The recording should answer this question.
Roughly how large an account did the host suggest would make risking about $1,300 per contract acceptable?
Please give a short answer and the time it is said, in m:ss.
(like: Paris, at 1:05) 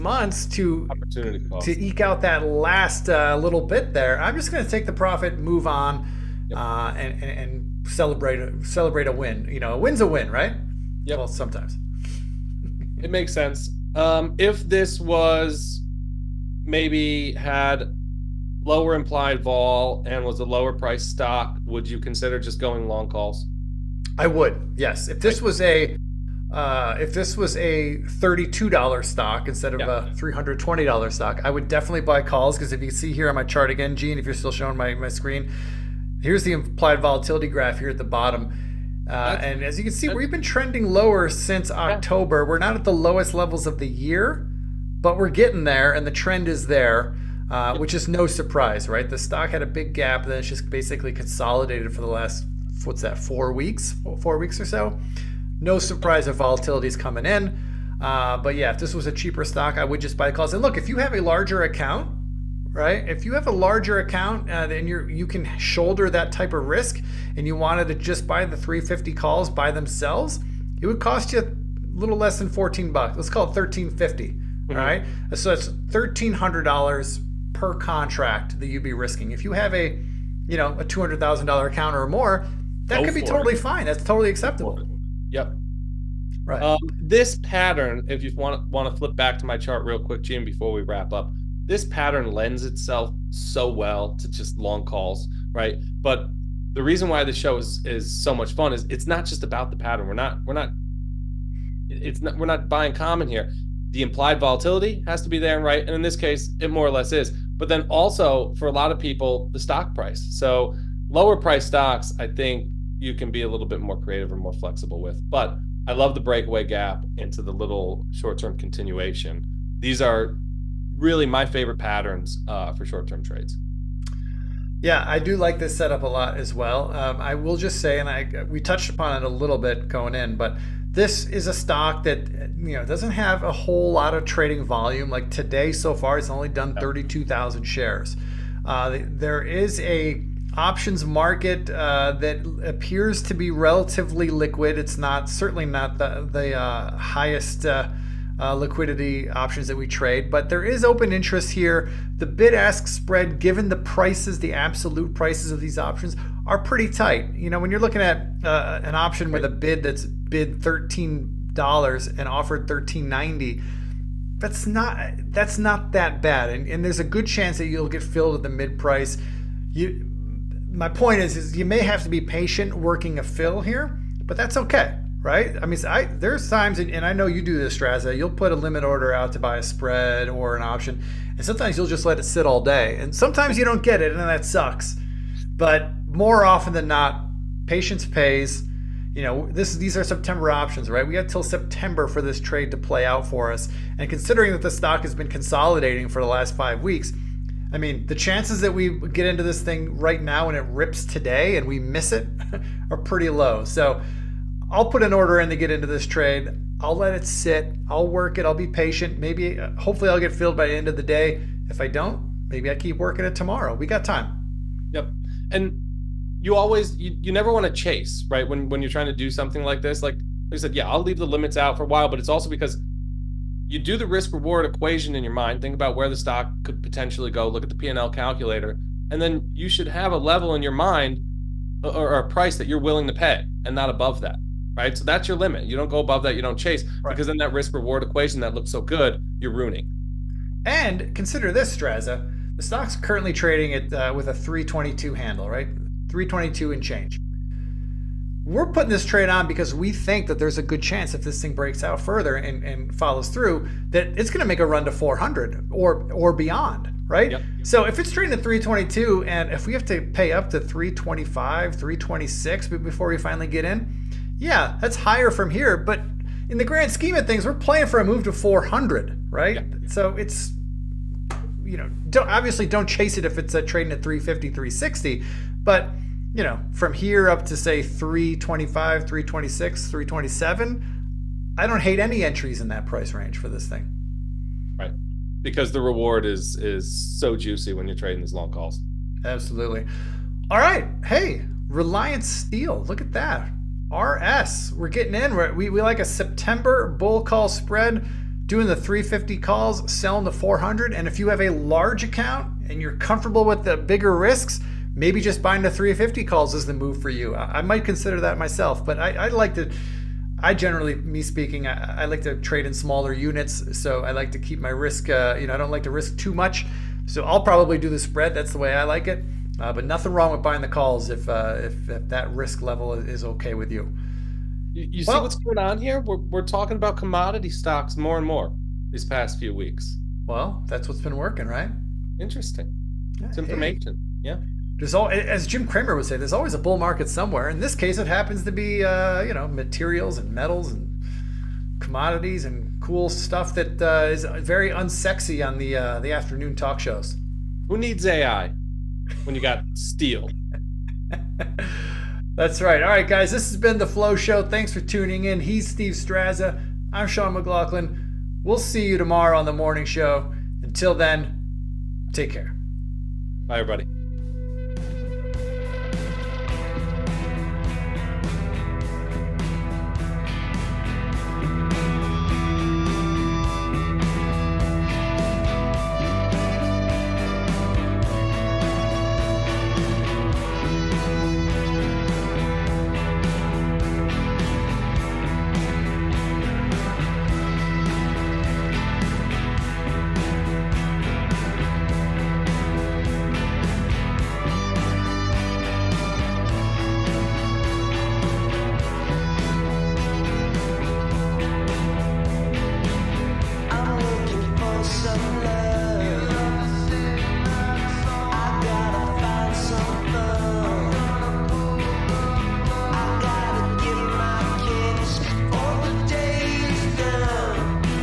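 $200,000, at 1:20.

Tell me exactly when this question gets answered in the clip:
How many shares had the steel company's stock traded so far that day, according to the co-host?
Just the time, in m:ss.
2:16.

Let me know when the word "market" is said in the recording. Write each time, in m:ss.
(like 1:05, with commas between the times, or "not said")
2:21, 5:36.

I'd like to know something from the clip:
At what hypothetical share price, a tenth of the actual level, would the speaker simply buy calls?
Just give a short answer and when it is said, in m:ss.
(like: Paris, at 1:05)
$32, at 0:28.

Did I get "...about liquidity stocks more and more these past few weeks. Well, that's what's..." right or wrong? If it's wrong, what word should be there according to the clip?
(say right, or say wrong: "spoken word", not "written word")
wrong: "commodity", not "liquidity".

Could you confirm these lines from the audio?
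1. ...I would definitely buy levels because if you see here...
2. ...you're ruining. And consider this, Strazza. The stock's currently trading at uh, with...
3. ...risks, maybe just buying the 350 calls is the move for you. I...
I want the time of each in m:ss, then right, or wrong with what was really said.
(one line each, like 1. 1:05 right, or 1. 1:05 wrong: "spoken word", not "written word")
1. 0:31 wrong: "calls", not "levels"
2. 3:59 right
3. 5:04 right.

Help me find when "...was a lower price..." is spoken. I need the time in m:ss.
0:20.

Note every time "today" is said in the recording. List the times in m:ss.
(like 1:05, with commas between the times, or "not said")
2:15, 3:21.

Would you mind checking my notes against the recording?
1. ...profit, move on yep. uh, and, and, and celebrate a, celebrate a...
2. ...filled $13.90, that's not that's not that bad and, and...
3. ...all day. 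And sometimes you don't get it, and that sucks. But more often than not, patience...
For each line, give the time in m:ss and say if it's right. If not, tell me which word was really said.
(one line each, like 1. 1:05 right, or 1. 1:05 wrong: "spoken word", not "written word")
1. 0:04 right
2. 2:42 wrong: "offered", not "filled"
3. 3:02 right.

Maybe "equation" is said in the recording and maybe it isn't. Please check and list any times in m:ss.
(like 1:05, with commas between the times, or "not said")
3:44, 3:58.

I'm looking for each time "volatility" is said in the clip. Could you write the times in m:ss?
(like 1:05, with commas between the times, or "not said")
0:37, 0:56, 1:44.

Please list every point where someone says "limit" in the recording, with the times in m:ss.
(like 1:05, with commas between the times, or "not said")
2:58, 3:41, 3:55.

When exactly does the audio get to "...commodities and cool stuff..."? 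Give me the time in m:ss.
5:41.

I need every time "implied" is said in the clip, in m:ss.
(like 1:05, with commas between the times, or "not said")
0:18, 0:36, 1:44.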